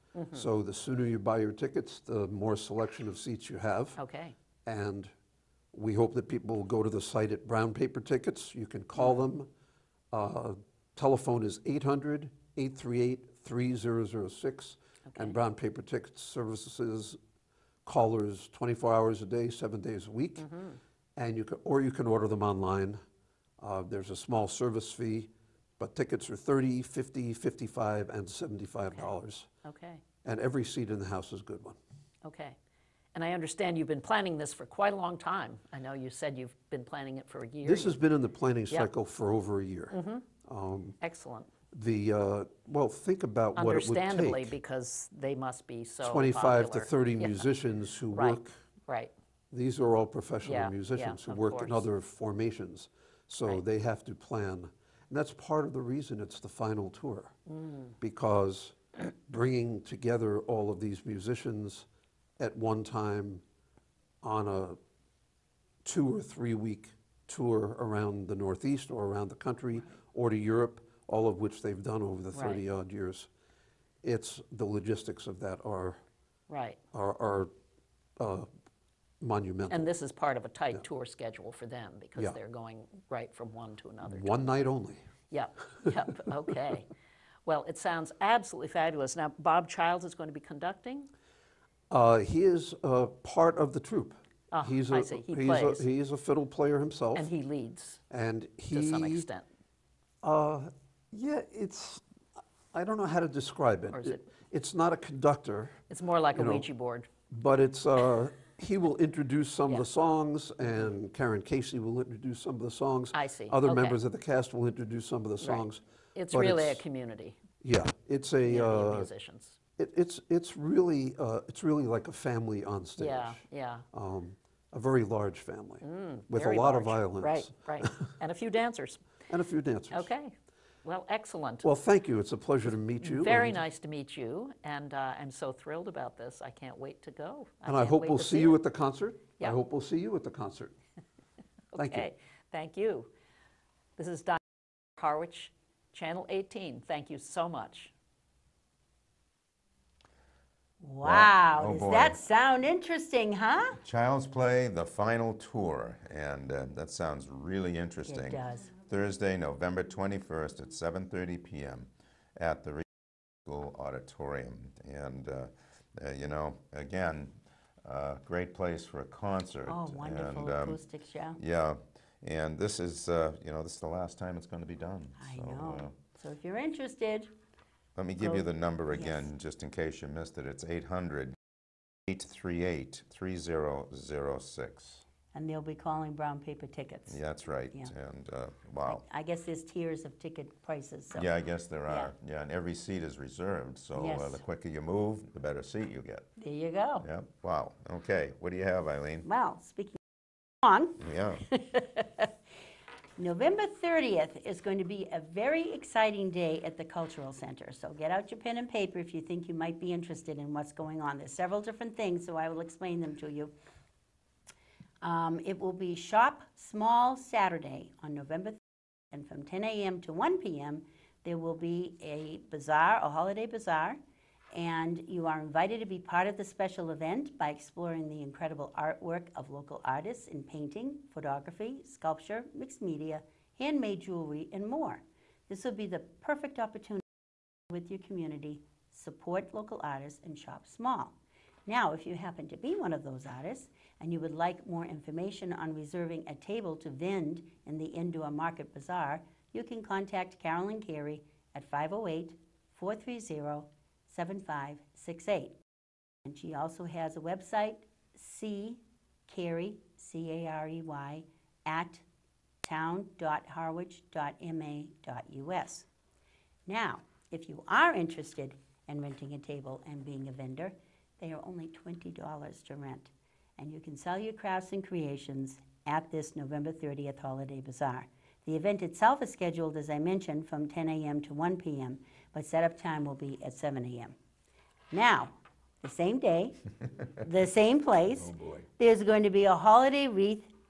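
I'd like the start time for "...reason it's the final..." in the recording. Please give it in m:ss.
0:55.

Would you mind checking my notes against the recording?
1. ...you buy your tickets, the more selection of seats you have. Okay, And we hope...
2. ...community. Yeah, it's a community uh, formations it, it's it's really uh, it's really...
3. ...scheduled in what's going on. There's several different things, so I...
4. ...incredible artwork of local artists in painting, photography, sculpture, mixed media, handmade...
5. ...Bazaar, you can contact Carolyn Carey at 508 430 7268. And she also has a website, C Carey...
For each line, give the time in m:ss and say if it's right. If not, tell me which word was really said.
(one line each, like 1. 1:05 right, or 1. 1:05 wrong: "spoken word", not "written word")
1. 0:01 right
2. 1:56 wrong: "musicians", not "formations"
3. 3:29 wrong: "interested", not "scheduled"
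4. 3:48 right
5. 4:08 wrong: "7568", not "7268".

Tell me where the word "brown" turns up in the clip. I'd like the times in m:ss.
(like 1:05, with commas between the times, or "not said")
0:07, 0:15, 3:06.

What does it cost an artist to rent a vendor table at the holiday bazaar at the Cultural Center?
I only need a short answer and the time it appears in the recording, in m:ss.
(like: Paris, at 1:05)
$20, at 4:31.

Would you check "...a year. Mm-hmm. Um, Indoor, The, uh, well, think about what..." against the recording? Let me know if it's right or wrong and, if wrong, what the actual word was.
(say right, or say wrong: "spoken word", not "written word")
wrong: "Excellent", not "Indoor".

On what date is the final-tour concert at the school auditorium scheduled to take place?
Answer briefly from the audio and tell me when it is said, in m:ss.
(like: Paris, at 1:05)
Thursday, November 21st, at 2:38.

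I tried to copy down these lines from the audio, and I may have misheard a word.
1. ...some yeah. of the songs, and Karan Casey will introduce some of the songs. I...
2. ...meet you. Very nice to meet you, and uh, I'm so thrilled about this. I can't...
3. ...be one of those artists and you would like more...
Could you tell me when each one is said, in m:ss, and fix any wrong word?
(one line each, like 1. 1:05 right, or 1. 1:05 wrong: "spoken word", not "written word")
1. 1:49 right
2. 2:12 right
3. 4:02 right.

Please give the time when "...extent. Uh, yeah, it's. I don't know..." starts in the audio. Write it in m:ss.
1:39.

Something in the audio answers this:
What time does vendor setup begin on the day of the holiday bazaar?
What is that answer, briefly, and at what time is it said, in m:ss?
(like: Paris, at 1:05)
7 a.m., at 4:43.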